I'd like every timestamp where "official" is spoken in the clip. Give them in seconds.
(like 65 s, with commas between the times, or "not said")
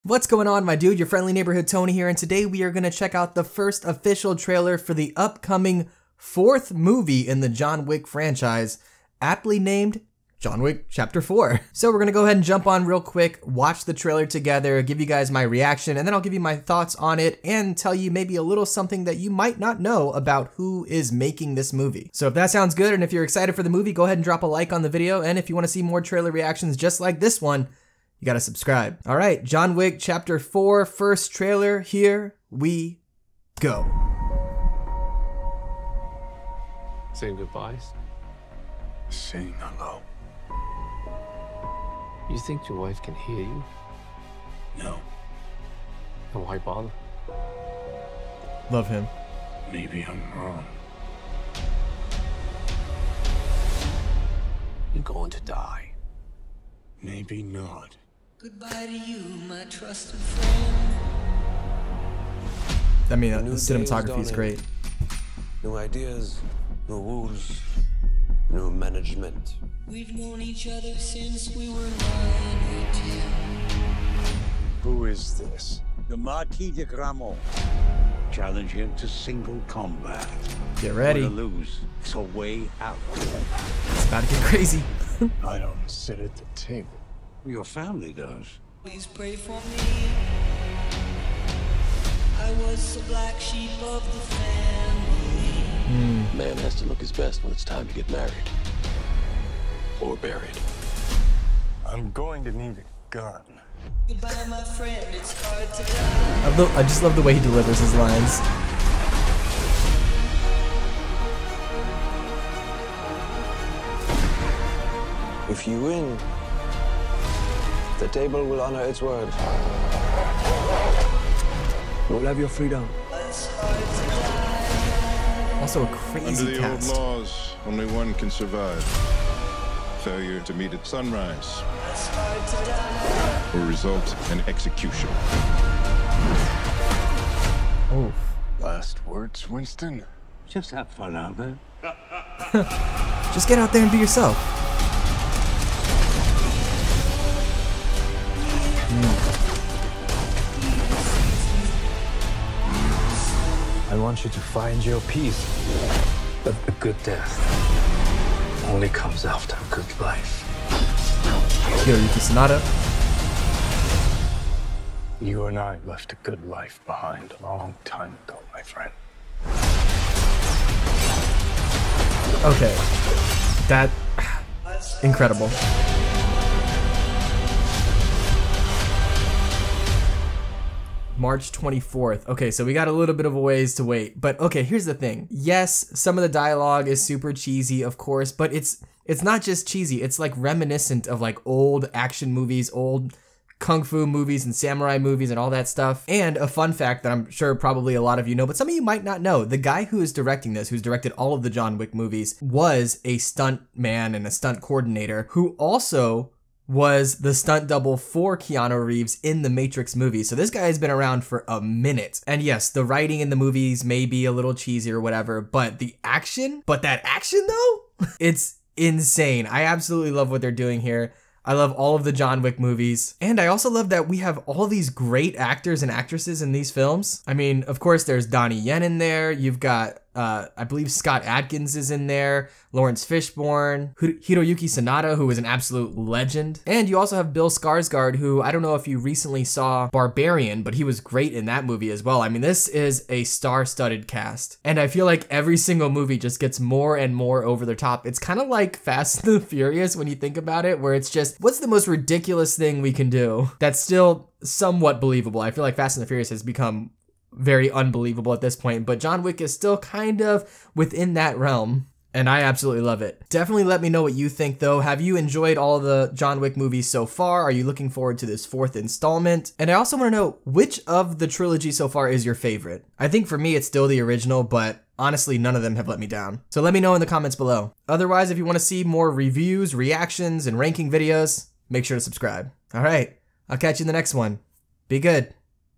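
3 s.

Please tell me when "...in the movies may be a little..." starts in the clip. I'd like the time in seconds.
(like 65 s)
213 s.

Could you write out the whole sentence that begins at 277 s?
Otherwise, if you want to see more reviews, reactions, and ranking videos, make sure to subscribe.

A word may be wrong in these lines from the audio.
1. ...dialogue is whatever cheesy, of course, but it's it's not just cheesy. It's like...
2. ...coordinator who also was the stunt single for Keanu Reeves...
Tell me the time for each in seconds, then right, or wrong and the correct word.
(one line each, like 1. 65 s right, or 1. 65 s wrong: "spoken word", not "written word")
1. 186 s wrong: "super", not "whatever"
2. 204 s wrong: "double", not "single".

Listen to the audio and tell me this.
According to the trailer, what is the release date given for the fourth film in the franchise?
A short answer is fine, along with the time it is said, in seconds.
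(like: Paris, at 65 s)
March 24th, at 181 s.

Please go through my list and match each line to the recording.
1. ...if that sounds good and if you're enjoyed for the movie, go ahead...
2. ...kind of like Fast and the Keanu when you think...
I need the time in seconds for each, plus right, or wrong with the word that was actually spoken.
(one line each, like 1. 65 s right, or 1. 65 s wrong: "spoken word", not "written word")
1. 22 s wrong: "excited", not "enjoyed"
2. 248 s wrong: "Furious", not "Keanu".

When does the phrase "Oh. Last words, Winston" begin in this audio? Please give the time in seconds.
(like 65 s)
137 s.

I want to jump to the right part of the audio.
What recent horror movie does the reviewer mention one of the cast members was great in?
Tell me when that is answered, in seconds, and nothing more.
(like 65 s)
239 s.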